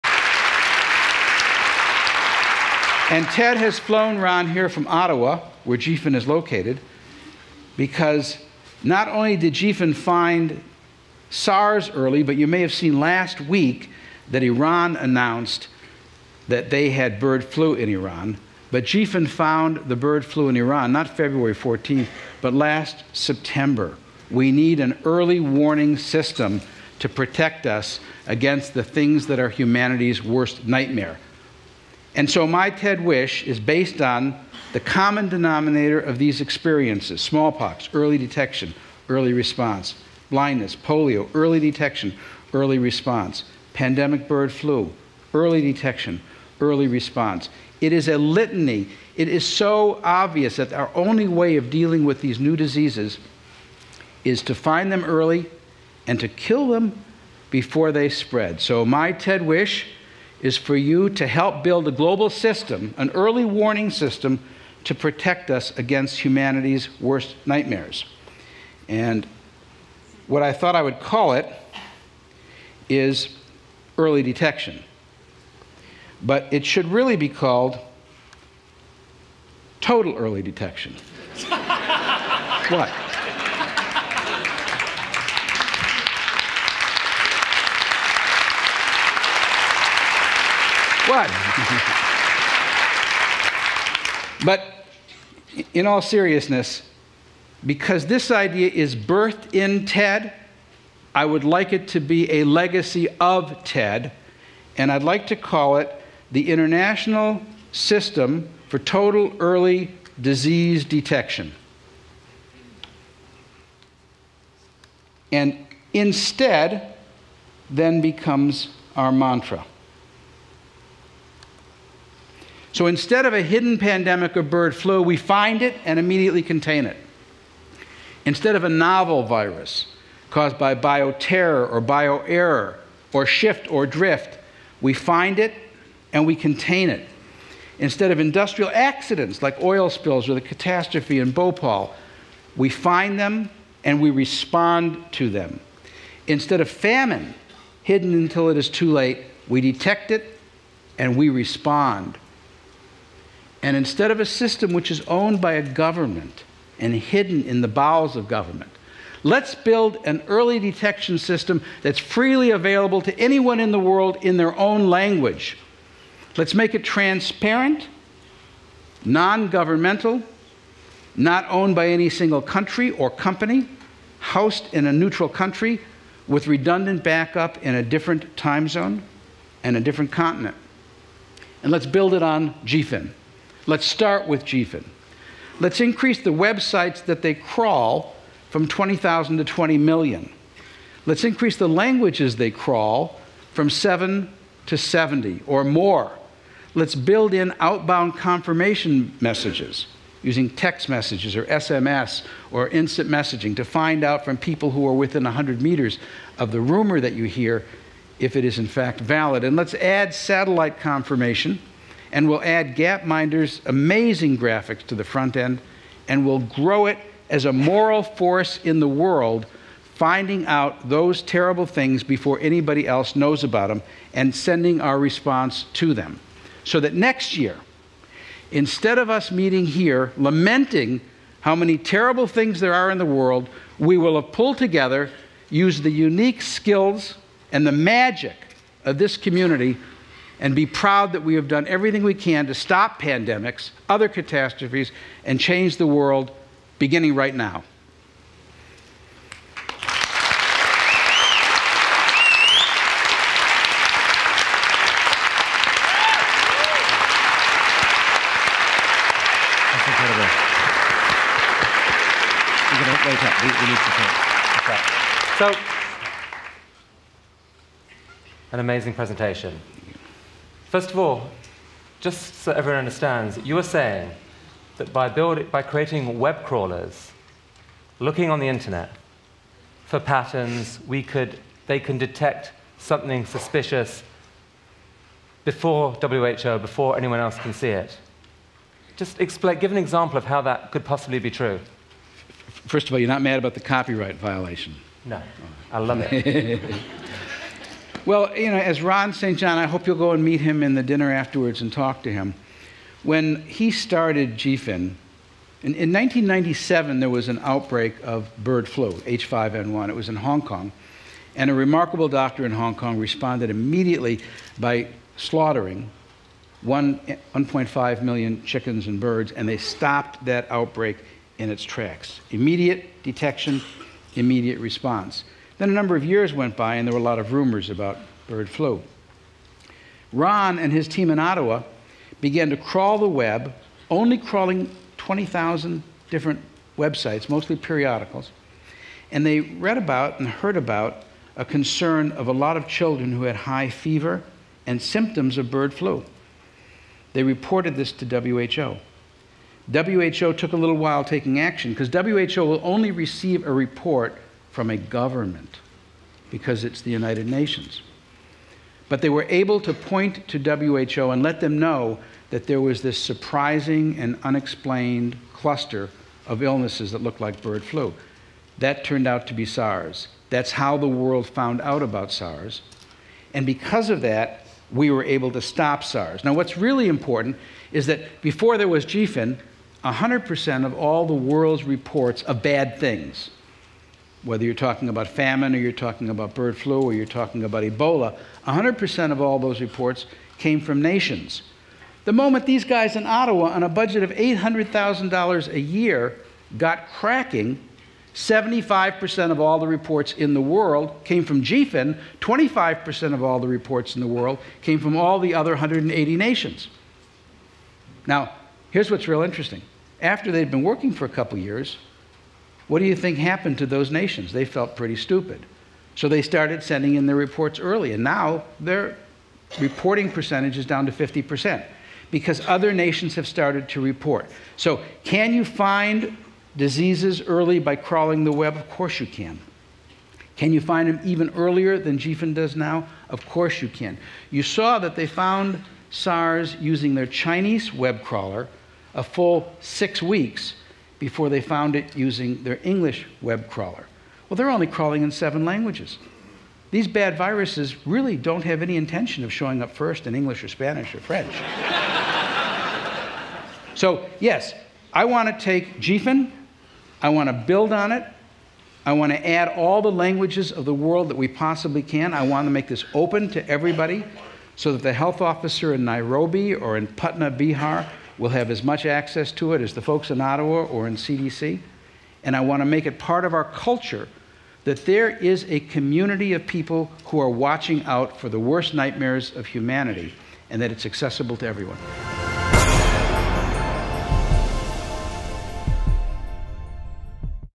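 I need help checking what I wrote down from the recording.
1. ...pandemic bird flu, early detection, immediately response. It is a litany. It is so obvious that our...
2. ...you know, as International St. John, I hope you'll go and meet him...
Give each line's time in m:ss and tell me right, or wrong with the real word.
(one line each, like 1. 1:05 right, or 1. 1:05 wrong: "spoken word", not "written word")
1. 0:43 wrong: "early", not "immediately"
2. 4:58 wrong: "Ron", not "International".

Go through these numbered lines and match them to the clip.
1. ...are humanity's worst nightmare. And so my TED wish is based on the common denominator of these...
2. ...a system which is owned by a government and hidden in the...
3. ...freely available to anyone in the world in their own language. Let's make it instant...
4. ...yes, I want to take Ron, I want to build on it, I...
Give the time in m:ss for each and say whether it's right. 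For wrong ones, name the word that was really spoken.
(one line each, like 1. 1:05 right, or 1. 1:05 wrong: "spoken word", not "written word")
1. 0:29 right
2. 2:34 right
3. 2:41 wrong: "transparent", not "instant"
4. 7:34 wrong: "GPHIN", not "Ron".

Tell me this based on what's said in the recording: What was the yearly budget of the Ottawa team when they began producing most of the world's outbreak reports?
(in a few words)
$800,000.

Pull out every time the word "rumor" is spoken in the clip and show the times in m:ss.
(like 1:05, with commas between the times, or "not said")
3:26, 5:27.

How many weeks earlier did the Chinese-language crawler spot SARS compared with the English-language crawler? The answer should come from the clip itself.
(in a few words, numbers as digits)
6 weeks.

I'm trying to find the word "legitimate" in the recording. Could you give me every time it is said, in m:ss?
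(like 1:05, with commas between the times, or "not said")
not said.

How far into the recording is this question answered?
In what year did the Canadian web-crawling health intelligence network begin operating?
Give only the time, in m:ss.
5:05.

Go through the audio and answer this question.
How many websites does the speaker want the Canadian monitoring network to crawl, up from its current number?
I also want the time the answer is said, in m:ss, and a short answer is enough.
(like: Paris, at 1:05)
20 million, at 3:09.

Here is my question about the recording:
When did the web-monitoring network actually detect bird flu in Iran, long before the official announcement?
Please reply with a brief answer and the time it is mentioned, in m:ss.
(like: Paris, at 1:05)
Last September, at 0:22.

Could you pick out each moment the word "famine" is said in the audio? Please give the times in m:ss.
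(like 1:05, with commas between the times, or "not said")
2:26, 6:25.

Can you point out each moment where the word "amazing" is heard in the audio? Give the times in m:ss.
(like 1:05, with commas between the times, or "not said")
3:33, 4:28.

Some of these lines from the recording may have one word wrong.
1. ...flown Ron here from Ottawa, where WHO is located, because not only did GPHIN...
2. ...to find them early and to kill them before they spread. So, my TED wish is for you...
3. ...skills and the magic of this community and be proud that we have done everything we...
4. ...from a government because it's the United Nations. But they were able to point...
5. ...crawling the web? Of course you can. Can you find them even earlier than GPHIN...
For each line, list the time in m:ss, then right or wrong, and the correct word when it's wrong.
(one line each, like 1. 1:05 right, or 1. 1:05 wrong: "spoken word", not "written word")
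1. 0:03 wrong: "GPHIN", not "WHO"
2. 0:54 right
3. 3:56 right
4. 5:54 right
5. 7:07 right.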